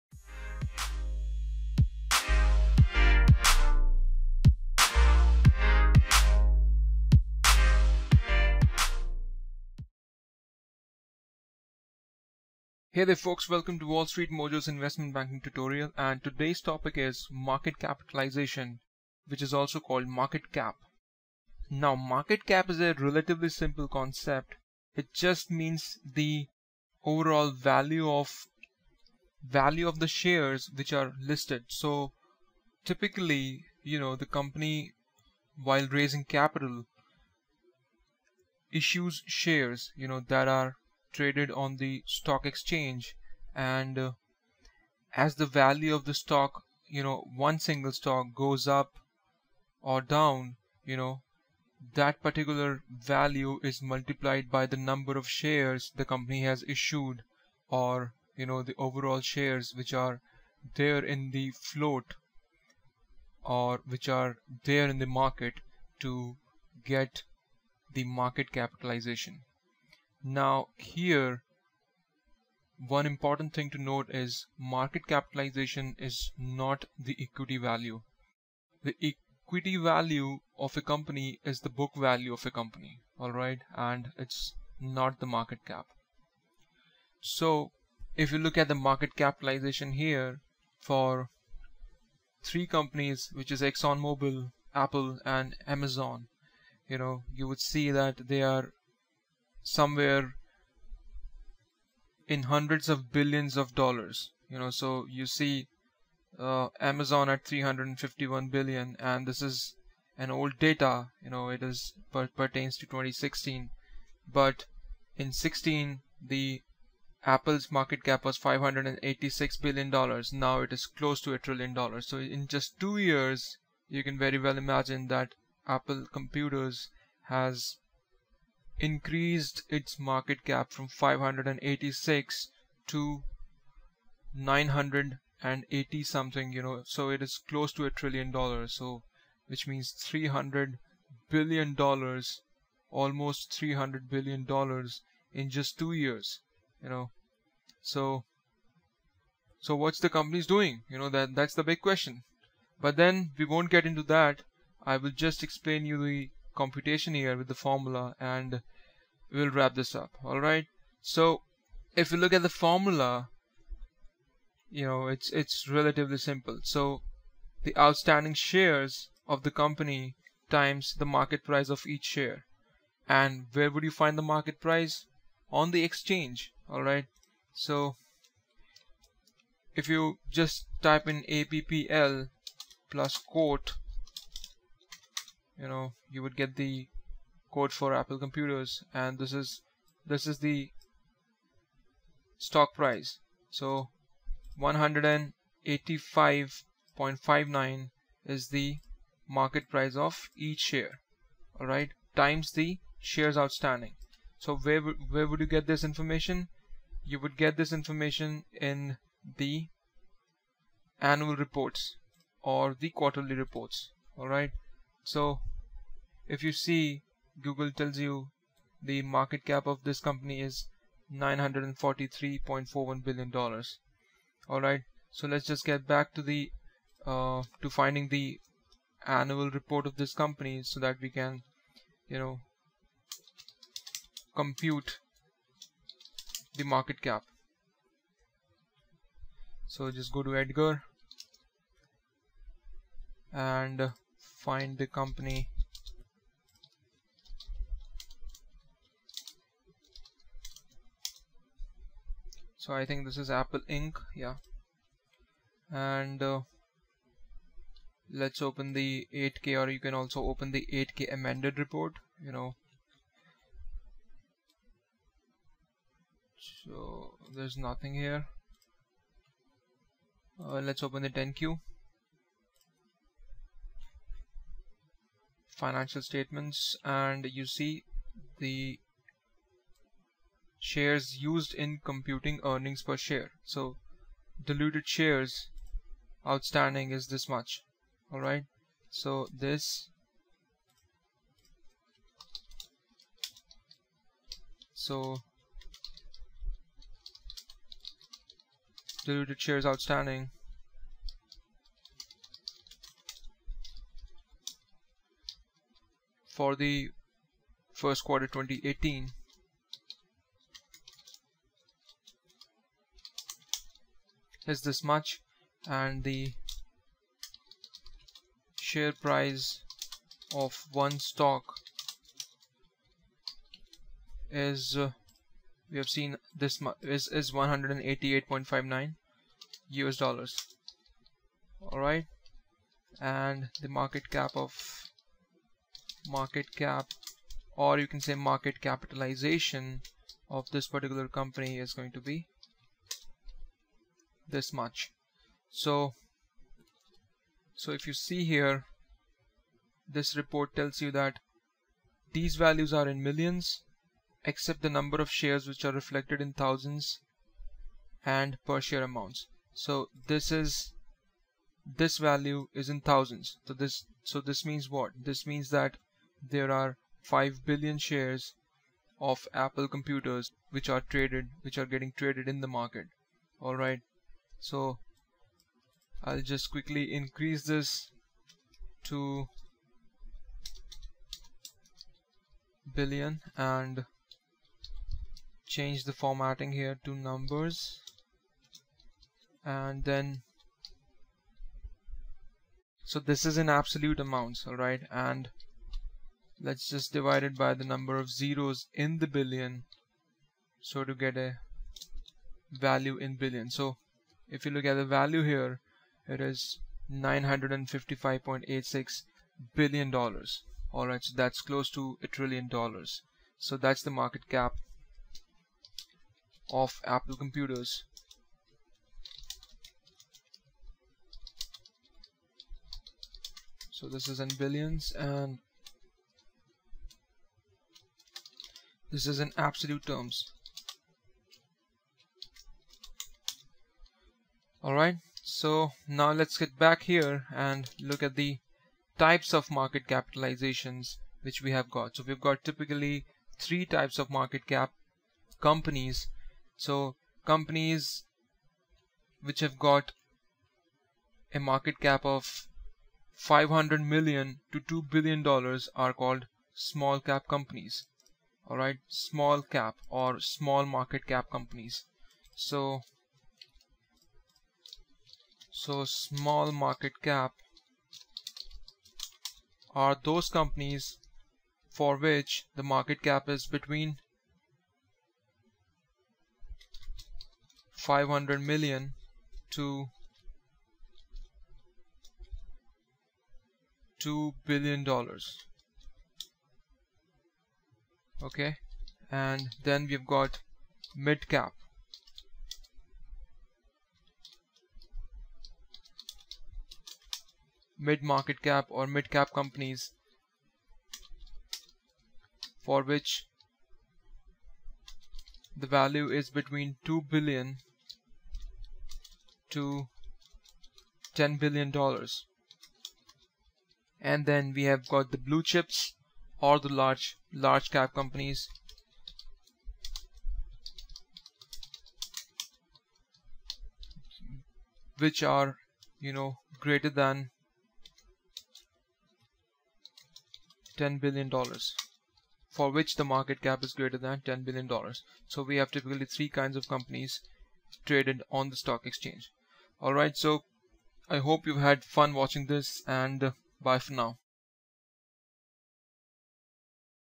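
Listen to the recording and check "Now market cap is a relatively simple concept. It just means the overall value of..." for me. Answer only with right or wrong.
right.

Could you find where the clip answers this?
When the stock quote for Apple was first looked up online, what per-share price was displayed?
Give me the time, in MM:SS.
03:14.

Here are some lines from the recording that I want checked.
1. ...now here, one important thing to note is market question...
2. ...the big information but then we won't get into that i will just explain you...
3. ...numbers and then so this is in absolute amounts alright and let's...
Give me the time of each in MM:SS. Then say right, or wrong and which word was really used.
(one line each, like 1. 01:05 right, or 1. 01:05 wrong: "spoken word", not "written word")
1. 01:10 wrong: "capitalization", not "question"
2. 02:31 wrong: "question", not "information"
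3. 06:26 right.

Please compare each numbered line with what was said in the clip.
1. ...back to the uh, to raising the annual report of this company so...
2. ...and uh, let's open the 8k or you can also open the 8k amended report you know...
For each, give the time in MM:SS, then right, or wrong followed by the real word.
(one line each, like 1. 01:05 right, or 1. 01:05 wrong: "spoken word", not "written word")
1. 03:45 wrong: "finding", not "raising"
2. 04:15 right.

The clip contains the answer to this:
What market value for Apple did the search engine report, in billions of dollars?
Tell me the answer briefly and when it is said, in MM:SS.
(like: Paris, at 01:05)
$943.41 billion, at 03:41.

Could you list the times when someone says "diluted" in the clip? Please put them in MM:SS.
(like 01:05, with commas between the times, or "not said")
04:44, 04:59.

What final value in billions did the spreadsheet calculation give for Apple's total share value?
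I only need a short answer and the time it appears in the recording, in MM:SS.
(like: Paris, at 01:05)
955.86 billion dollars, at 06:46.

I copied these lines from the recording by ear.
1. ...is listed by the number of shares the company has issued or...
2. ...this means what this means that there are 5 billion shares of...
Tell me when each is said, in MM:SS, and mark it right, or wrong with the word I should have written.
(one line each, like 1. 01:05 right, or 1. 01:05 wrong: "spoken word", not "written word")
1. 00:53 wrong: "multiplied", not "listed"
2. 06:04 right.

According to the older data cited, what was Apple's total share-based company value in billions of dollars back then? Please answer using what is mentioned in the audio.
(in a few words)
586 billion dollars.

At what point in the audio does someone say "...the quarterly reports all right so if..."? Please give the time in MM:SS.
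03:32.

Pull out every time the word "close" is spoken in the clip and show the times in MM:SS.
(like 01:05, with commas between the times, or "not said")
02:00, 02:17, 06:51.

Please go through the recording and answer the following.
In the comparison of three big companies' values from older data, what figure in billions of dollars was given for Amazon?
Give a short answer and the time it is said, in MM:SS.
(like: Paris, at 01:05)
351 billion, at 01:47.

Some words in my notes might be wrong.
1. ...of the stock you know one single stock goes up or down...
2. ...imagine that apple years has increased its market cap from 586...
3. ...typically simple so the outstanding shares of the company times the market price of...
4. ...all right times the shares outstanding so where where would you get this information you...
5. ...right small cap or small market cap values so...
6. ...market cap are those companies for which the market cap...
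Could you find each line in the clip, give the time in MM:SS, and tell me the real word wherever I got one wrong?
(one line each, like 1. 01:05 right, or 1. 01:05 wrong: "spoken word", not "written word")
1. 00:45 right
2. 02:04 wrong: "computers", not "years"
3. 02:45 wrong: "relatively", not "typically"
4. 03:21 right
5. 07:38 wrong: "companies", not "values"
6. 07:46 right.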